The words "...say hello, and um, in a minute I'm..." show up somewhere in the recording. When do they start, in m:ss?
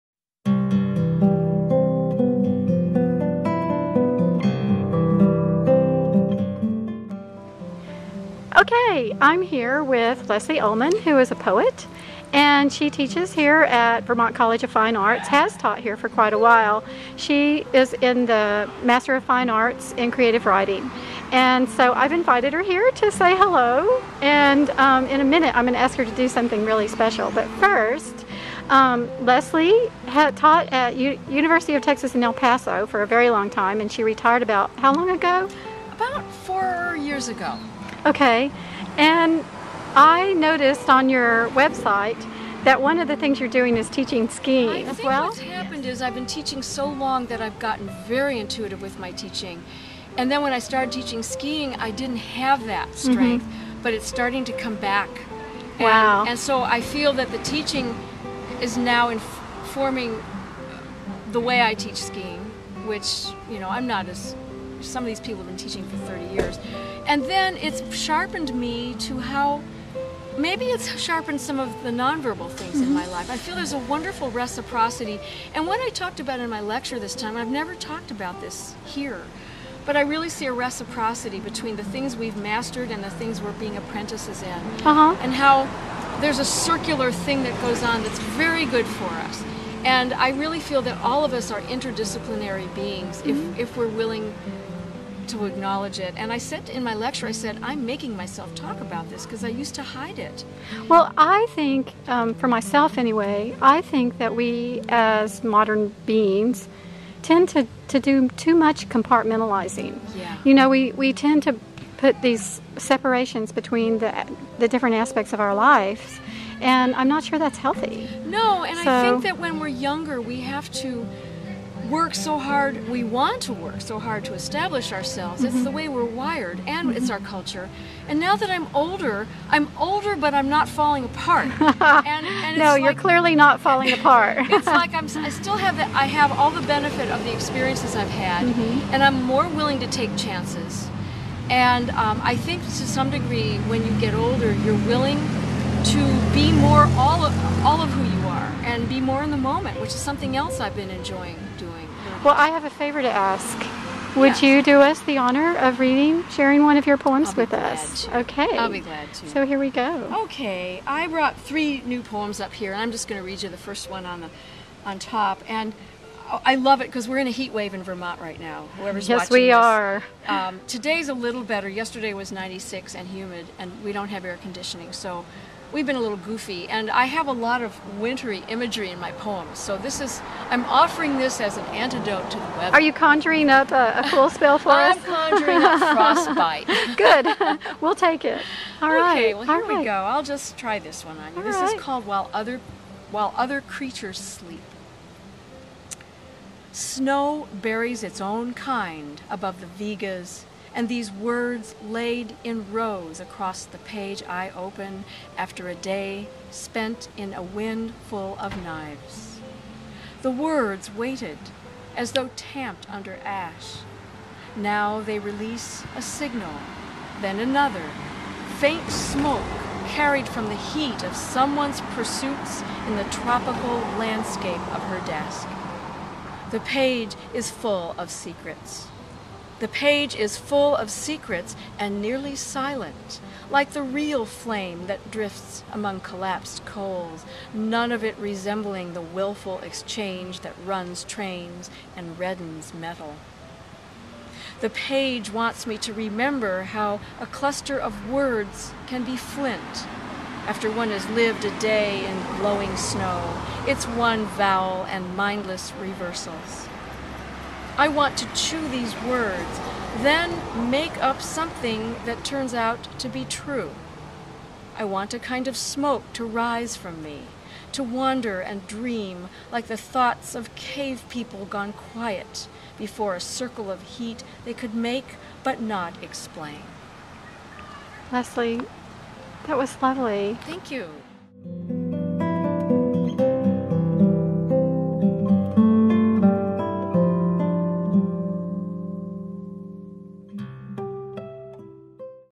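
0:23.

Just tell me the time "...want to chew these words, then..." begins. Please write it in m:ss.
4:17.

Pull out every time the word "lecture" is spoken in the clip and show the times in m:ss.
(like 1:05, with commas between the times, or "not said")
1:16, 1:36.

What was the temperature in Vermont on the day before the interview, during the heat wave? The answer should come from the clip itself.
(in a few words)
96.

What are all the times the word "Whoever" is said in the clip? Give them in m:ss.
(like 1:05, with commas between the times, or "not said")
2:48.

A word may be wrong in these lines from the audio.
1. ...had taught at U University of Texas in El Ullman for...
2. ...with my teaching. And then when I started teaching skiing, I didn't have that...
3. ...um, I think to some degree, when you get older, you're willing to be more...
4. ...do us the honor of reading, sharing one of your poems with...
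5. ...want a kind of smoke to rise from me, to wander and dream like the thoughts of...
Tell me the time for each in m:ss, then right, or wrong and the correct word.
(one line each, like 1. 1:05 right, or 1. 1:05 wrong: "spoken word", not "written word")
1. 0:30 wrong: "Paso", not "Ullman"
2. 0:48 right
3. 2:21 right
4. 2:34 right
5. 4:24 right.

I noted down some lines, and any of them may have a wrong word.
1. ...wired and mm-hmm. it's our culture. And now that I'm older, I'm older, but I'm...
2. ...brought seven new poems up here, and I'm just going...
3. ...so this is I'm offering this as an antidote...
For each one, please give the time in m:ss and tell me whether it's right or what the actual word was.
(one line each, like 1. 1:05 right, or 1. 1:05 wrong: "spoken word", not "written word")
1. 2:06 right
2. 2:41 wrong: "three", not "seven"
3. 2:59 right.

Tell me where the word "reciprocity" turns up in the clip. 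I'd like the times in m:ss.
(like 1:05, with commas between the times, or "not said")
1:14, 1:20.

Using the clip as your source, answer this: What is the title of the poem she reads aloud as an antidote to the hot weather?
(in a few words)
While Other Creatures Sleep.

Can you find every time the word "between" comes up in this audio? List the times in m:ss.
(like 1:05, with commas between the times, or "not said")
1:21, 1:53.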